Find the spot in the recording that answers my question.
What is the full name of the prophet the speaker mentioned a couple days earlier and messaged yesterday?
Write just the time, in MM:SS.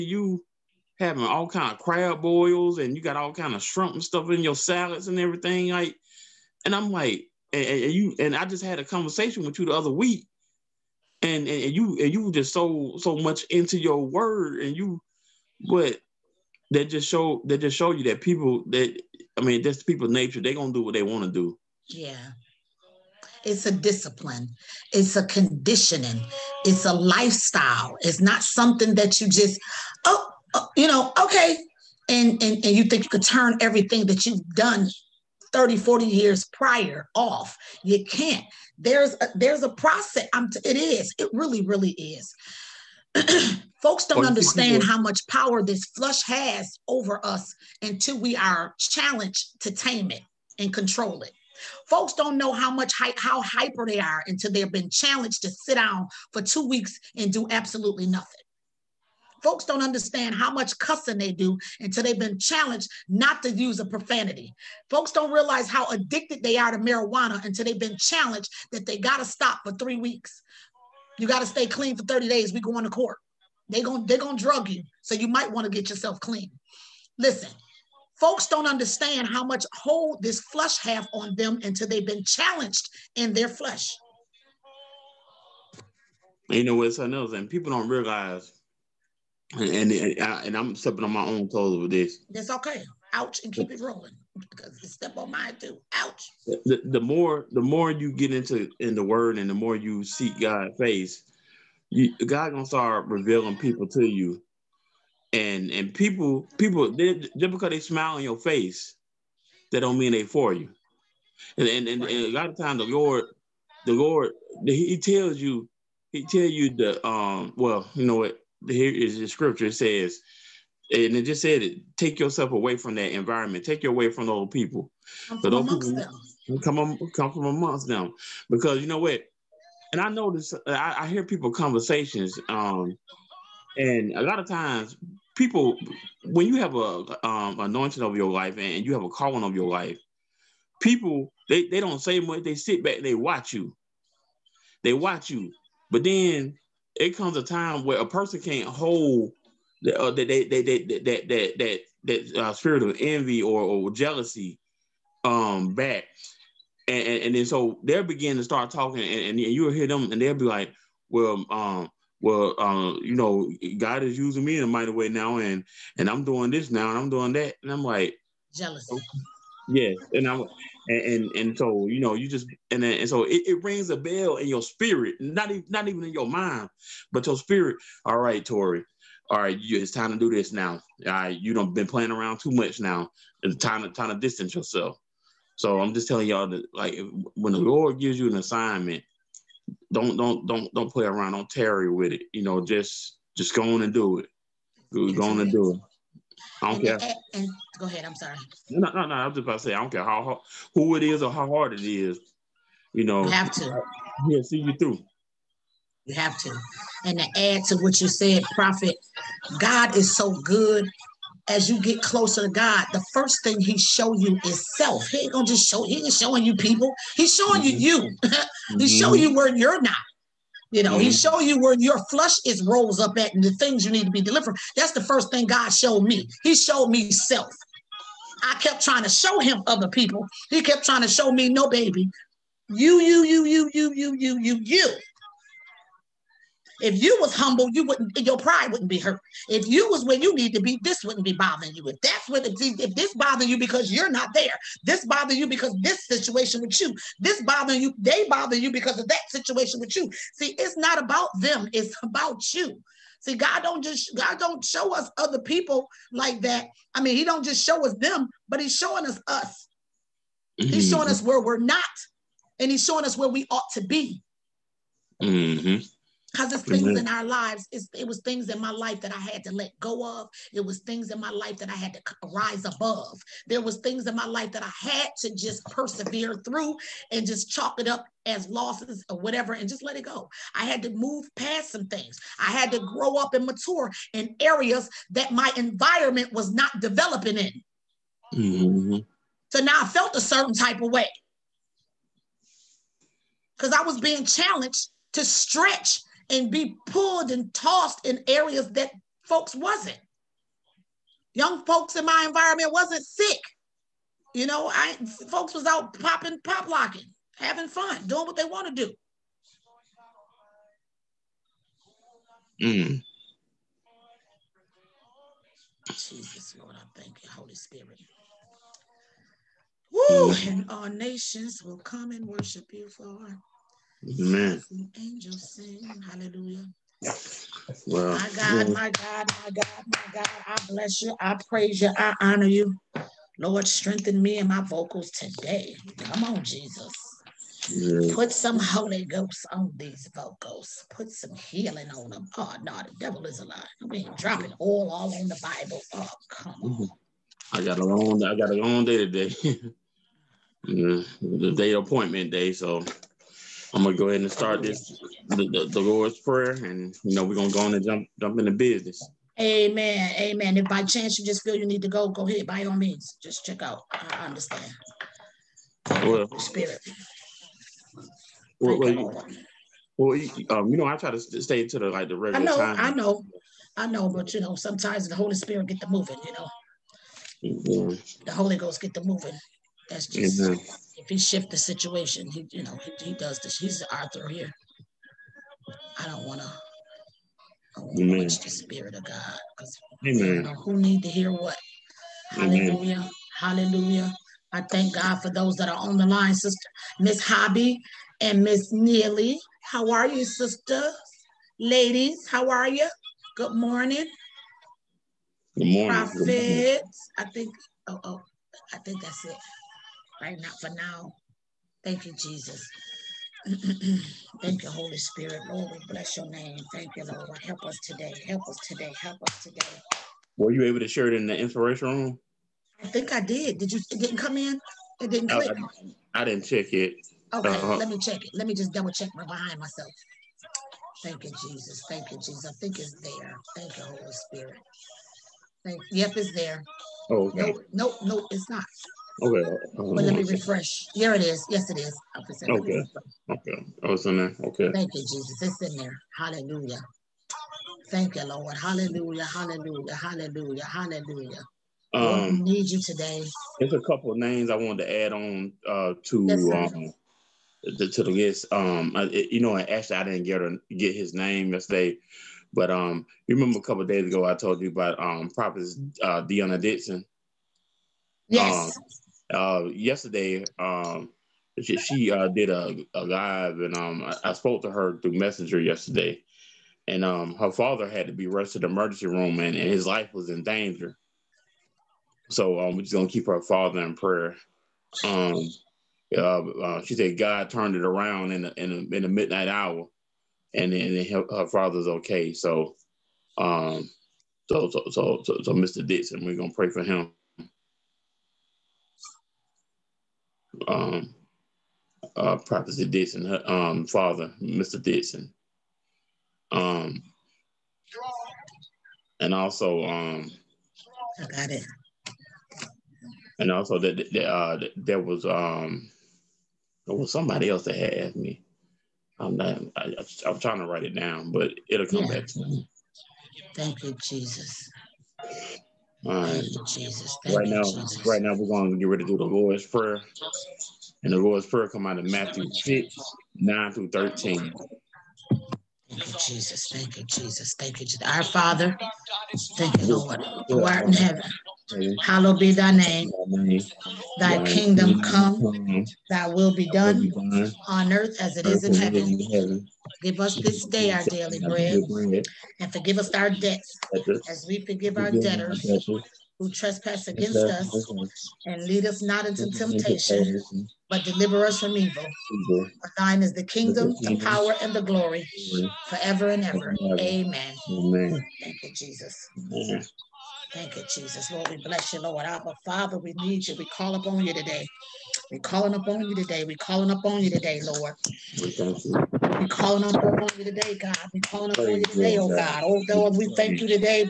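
07:46.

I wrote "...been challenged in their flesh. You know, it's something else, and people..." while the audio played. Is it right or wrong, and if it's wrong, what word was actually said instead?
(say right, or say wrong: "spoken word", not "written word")
right.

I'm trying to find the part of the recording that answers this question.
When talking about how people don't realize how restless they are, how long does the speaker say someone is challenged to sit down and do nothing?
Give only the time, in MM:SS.
00:56.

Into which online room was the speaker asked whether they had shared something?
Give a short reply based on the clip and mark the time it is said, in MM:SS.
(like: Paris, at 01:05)
inspiration room, at 07:01.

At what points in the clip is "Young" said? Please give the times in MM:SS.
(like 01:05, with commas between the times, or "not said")
05:01.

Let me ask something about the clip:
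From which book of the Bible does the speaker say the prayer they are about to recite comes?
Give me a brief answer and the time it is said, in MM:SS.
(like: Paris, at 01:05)
Matthew, at 08:52.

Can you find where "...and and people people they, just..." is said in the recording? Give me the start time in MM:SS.
01:45.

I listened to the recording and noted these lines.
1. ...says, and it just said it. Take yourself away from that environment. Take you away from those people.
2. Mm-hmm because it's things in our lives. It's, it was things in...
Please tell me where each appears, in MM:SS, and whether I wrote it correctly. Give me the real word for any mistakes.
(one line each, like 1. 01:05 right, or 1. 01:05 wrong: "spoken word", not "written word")
1. 01:59 right
2. 04:25 right.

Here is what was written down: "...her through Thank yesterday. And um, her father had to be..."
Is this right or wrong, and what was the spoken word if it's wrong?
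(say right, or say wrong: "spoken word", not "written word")
wrong: "Messenger", not "Thank".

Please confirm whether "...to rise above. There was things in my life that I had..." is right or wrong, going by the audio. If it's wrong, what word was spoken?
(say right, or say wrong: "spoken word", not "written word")
right.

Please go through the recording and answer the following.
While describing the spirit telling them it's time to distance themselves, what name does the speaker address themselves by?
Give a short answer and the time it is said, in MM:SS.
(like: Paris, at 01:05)
Tori, at 02:58.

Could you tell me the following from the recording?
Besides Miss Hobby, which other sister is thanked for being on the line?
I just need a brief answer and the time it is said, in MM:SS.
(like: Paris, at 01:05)
Miss Neely, at 06:38.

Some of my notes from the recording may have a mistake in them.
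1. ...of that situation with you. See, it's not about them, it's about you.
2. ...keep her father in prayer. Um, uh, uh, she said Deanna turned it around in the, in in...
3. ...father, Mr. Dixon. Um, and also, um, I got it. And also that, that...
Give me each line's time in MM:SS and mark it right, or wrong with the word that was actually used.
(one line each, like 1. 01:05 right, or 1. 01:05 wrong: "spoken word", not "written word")
1. 04:08 right
2. 08:03 wrong: "God", not "Deanna"
3. 08:23 right.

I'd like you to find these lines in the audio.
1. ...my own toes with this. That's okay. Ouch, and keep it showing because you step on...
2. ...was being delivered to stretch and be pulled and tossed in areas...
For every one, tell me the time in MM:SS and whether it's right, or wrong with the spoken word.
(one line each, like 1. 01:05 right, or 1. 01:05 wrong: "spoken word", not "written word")
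1. 01:31 wrong: "rolling", not "showing"
2. 04:53 wrong: "challenged", not "delivered".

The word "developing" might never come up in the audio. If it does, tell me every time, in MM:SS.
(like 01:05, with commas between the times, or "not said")
04:46.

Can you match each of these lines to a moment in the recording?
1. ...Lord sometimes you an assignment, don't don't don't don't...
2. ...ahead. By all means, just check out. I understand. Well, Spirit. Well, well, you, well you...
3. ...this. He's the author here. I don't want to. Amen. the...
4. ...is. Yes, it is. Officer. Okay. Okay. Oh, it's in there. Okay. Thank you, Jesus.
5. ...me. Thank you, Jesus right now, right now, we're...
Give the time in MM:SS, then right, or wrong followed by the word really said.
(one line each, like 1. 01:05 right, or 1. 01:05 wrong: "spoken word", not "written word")
1. 03:07 wrong: "gives", not "sometimes"
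2. 06:02 right
3. 06:23 right
4. 07:21 right
5. 08:42 right.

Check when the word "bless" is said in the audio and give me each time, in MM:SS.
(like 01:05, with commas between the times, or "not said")
05:30, 06:55, 09:31.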